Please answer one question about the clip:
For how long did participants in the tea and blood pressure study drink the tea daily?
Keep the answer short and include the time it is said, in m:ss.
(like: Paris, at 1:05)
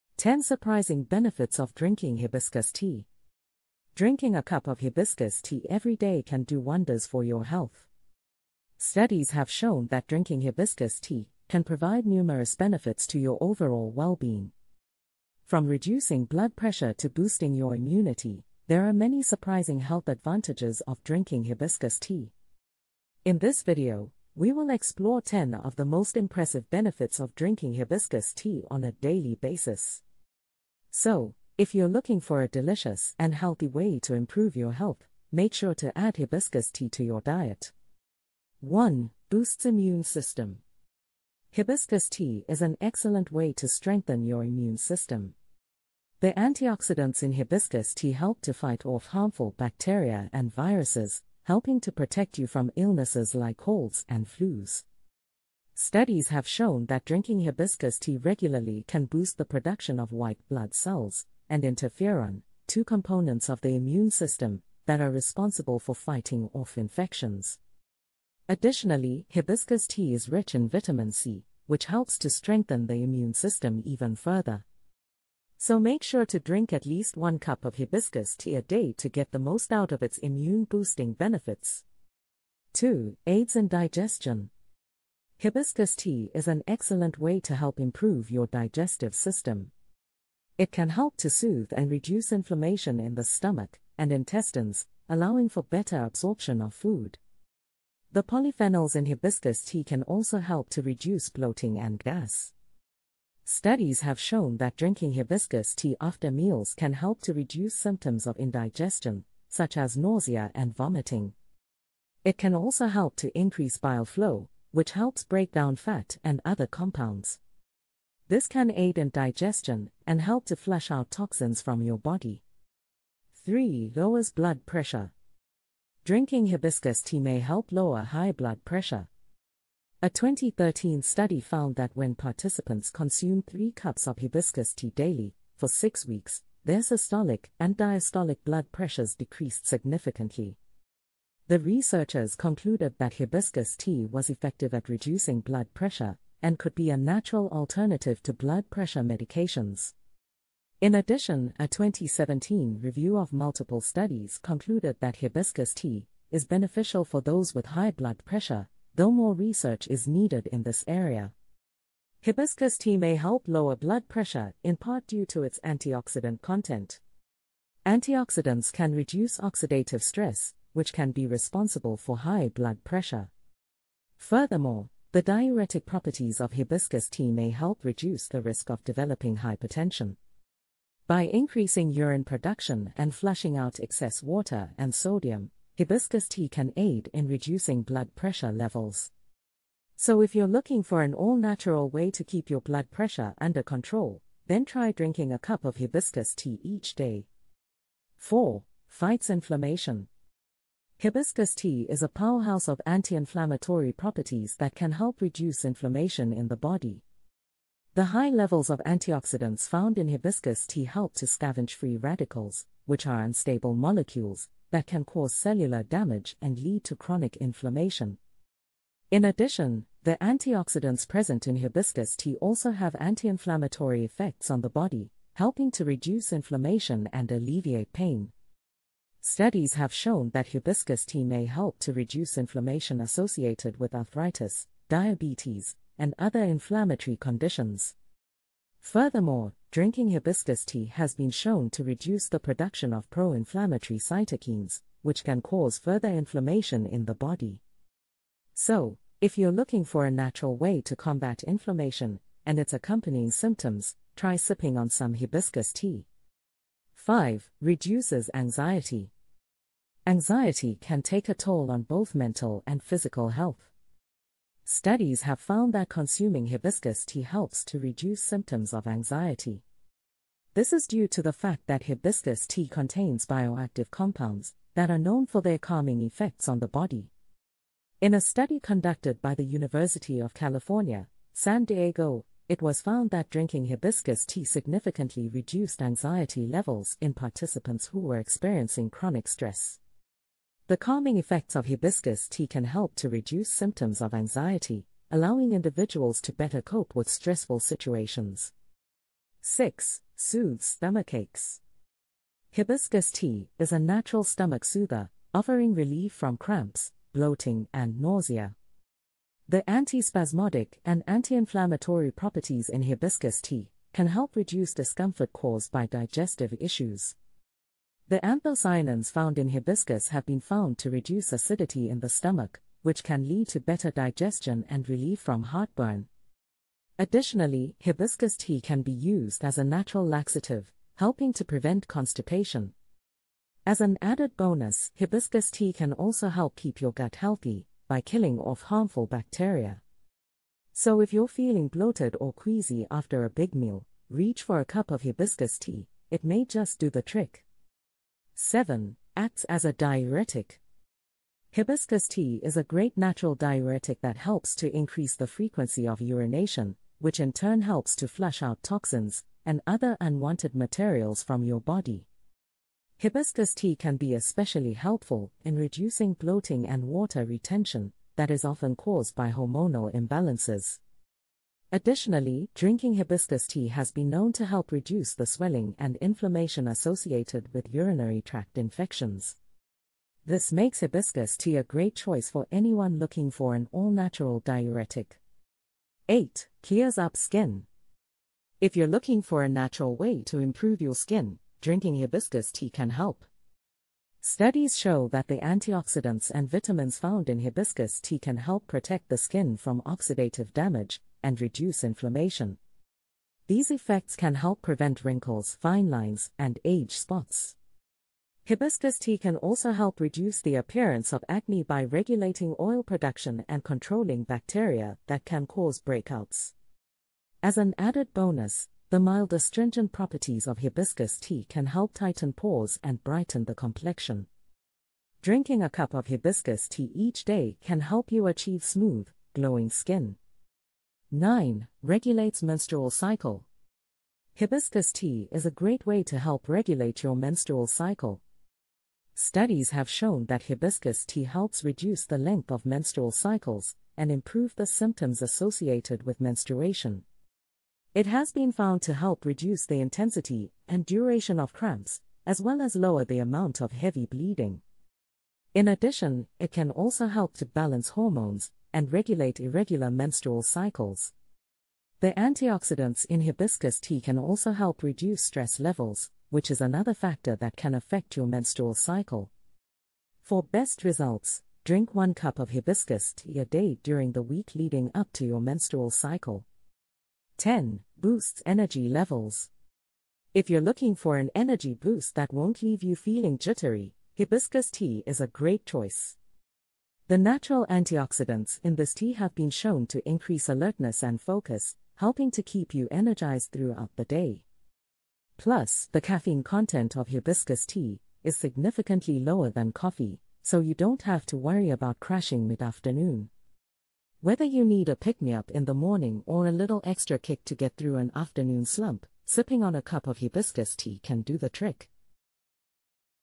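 6 weeks, at 2:15.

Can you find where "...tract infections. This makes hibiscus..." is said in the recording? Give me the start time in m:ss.
6:18.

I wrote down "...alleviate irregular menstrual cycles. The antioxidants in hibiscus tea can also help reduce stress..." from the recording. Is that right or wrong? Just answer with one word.
wrong.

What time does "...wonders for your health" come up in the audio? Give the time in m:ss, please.
0:06.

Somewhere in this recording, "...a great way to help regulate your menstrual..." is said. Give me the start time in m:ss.
7:15.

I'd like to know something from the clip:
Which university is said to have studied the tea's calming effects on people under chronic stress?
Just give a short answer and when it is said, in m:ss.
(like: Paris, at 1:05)
University of California, San Diego, at 4:39.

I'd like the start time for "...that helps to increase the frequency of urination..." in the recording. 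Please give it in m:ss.
5:53.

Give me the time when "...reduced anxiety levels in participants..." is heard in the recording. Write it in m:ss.
4:45.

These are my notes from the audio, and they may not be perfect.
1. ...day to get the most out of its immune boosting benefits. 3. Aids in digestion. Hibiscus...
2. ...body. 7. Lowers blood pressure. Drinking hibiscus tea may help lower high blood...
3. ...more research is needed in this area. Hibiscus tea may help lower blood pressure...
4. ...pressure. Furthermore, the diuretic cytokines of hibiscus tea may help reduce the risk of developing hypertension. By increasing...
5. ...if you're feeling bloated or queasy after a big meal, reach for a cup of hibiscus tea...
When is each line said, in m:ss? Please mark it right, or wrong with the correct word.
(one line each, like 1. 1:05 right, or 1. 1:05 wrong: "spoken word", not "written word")
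1. 1:18 wrong: "2", not "3"
2. 2:01 wrong: "3", not "7"
3. 2:39 right
4. 2:52 wrong: "properties", not "cytokines"
5. 5:41 right.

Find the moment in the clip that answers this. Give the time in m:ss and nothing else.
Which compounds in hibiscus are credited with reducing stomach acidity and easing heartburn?
5:18.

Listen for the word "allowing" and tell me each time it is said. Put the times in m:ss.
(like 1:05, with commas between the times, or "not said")
1:35, 4:55.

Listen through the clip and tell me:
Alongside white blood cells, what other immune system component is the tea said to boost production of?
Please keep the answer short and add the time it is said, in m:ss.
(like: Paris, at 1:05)
interferon, at 1:01.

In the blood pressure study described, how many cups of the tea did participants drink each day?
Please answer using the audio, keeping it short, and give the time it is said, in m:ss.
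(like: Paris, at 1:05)
3 cups, at 2:13.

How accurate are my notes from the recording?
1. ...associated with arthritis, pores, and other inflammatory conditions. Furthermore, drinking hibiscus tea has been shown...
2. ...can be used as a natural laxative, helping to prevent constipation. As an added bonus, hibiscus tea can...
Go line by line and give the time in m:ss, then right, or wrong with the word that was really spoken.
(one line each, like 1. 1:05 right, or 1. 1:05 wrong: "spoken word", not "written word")
1. 3:52 wrong: "diabetes", not "pores"
2. 5:28 right.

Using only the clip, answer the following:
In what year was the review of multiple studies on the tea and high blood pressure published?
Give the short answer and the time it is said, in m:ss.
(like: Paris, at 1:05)
2017, at 2:31.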